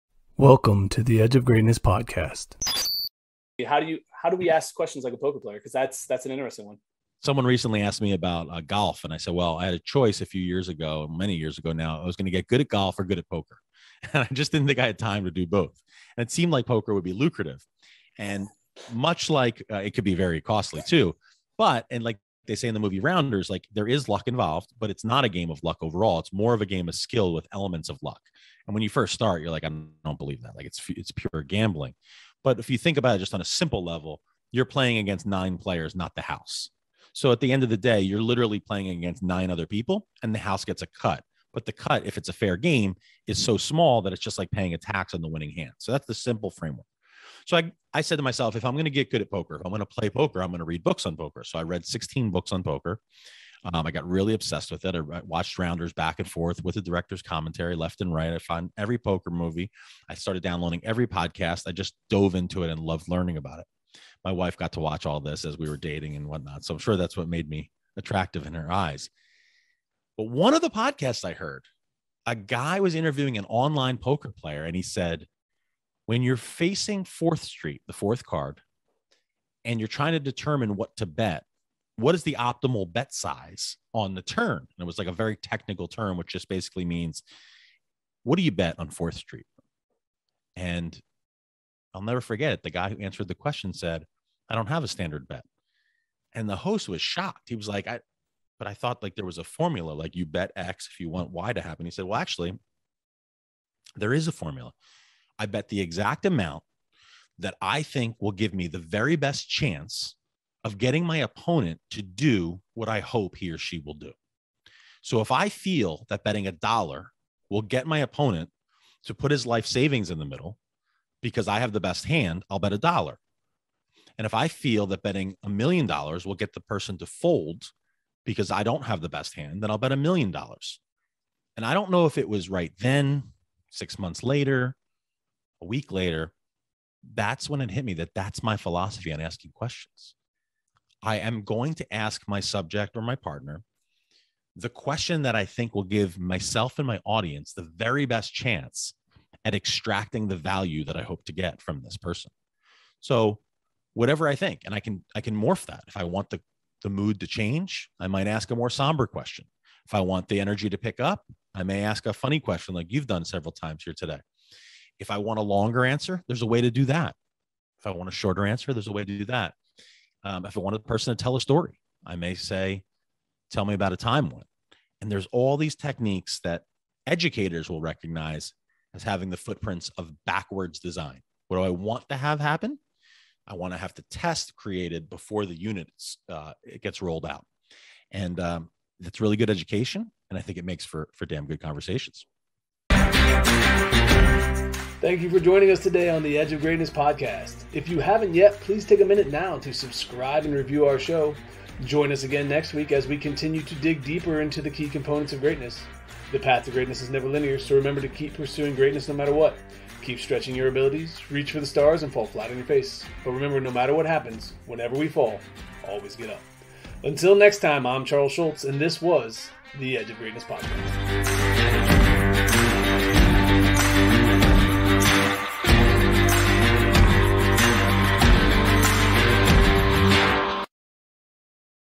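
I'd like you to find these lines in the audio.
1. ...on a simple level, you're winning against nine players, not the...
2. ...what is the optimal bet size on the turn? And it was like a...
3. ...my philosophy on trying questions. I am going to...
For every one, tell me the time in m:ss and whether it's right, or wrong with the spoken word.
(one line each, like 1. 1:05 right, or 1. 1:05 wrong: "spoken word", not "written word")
1. 0:33 wrong: "playing", not "winning"
2. 1:22 right
3. 2:18 wrong: "asking", not "trying".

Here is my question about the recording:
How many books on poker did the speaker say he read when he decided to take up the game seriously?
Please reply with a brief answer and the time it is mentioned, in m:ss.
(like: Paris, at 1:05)
16, at 0:51.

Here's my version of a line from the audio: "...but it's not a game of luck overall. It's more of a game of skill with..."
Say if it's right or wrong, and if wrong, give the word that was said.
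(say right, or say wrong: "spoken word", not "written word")
right.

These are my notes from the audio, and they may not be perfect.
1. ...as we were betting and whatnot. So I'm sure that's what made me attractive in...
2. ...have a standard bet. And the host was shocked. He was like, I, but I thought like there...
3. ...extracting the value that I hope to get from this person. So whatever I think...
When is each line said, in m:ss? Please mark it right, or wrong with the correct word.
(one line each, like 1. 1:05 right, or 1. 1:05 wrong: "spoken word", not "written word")
1. 1:05 wrong: "dating", not "betting"
2. 1:34 right
3. 2:29 right.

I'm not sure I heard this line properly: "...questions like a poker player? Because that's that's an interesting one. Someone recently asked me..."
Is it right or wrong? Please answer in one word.
right.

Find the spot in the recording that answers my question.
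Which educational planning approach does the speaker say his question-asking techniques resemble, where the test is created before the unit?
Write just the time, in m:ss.
3:00.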